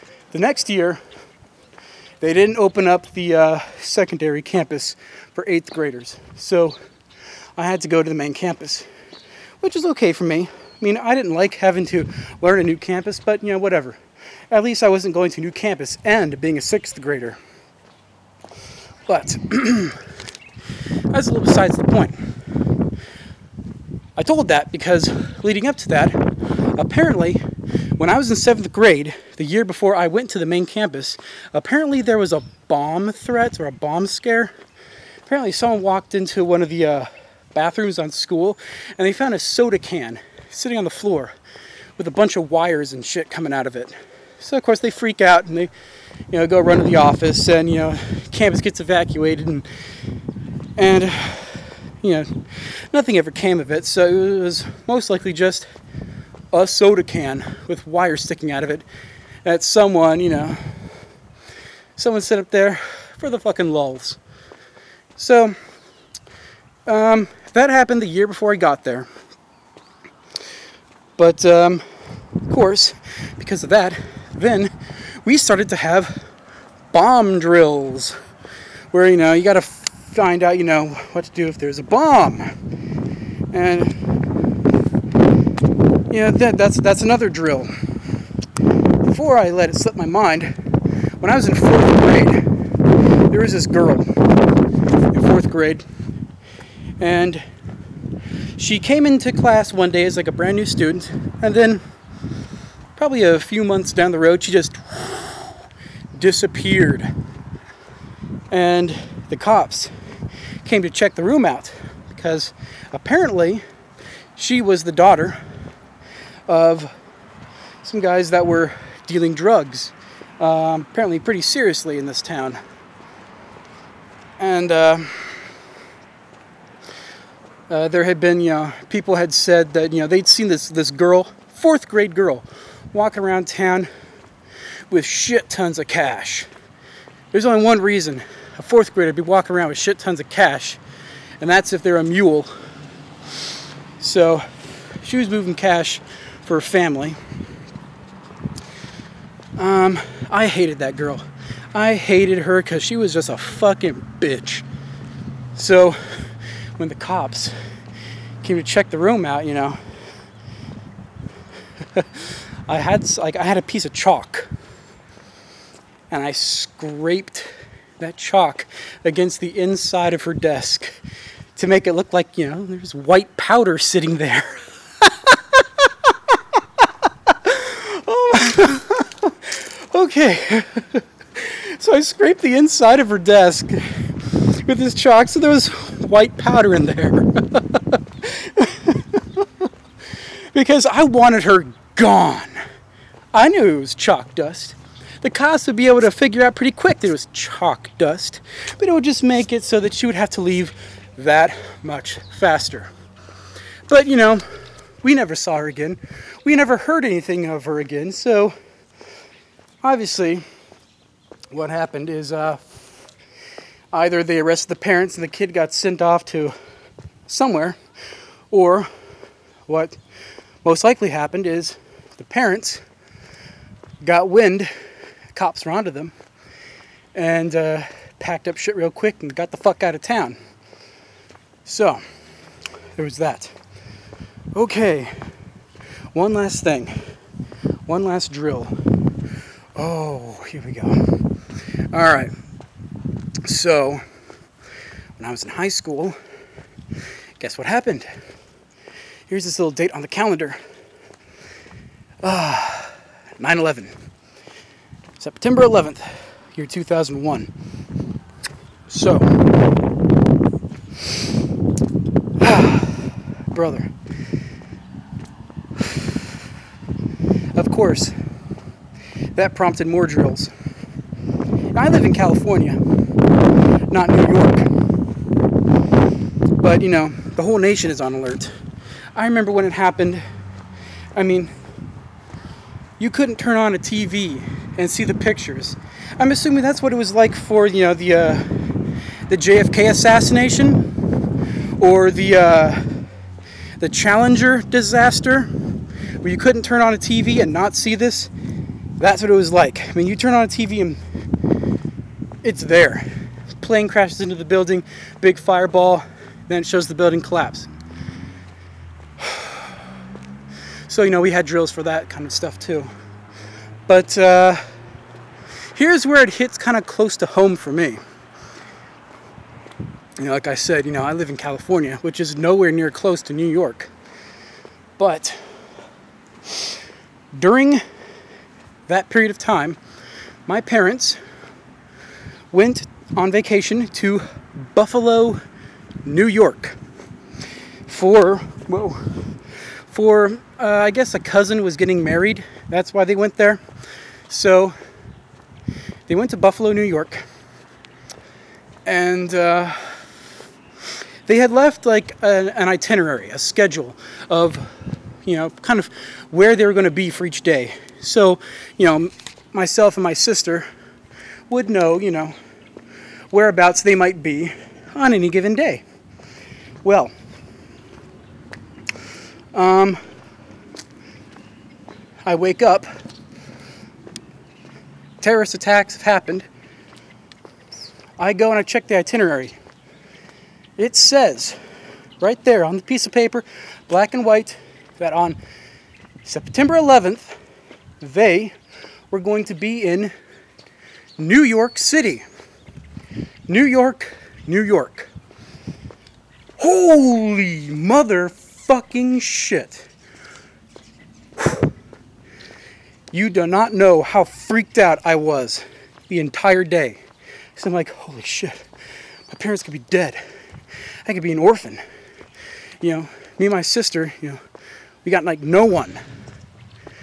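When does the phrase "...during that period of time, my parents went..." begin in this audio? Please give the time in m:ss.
5:27.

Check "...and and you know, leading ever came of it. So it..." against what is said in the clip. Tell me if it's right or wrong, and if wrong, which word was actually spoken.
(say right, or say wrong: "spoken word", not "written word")
wrong: "nothing", not "leading".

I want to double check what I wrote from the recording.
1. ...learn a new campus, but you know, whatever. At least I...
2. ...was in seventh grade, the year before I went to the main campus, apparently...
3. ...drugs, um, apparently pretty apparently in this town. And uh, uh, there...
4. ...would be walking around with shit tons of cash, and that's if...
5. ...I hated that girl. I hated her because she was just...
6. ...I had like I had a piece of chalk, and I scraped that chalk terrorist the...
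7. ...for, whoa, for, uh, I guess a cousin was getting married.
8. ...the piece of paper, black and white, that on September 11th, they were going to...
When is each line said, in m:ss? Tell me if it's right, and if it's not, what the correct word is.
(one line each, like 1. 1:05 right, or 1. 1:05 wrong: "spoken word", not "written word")
1. 0:12 right
2. 0:28 right
3. 1:59 wrong: "seriously", not "apparently"
4. 2:19 right
5. 2:30 right
6. 2:42 wrong: "against", not "terrorist"
7. 5:37 right
8. 6:22 right.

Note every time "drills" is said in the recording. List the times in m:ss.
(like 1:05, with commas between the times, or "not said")
1:17, 1:27, 3:58, 4:30, 5:11.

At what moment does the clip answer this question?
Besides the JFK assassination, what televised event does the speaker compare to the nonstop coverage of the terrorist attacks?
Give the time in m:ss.
4:53.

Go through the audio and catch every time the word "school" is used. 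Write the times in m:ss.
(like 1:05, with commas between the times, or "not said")
0:38, 4:05.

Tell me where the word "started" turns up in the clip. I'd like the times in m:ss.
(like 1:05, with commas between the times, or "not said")
1:15.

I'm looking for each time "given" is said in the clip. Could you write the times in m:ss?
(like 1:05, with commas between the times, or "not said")
6:05.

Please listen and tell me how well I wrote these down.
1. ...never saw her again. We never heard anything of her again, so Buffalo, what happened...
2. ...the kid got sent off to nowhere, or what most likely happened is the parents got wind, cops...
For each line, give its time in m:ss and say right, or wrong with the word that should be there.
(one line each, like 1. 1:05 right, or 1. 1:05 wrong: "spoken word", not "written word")
1. 3:25 wrong: "Obviously", not "Buffalo"
2. 3:35 wrong: "somewhere", not "nowhere".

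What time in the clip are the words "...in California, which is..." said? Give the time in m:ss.
5:21.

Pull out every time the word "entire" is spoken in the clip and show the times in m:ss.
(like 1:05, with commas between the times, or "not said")
6:46.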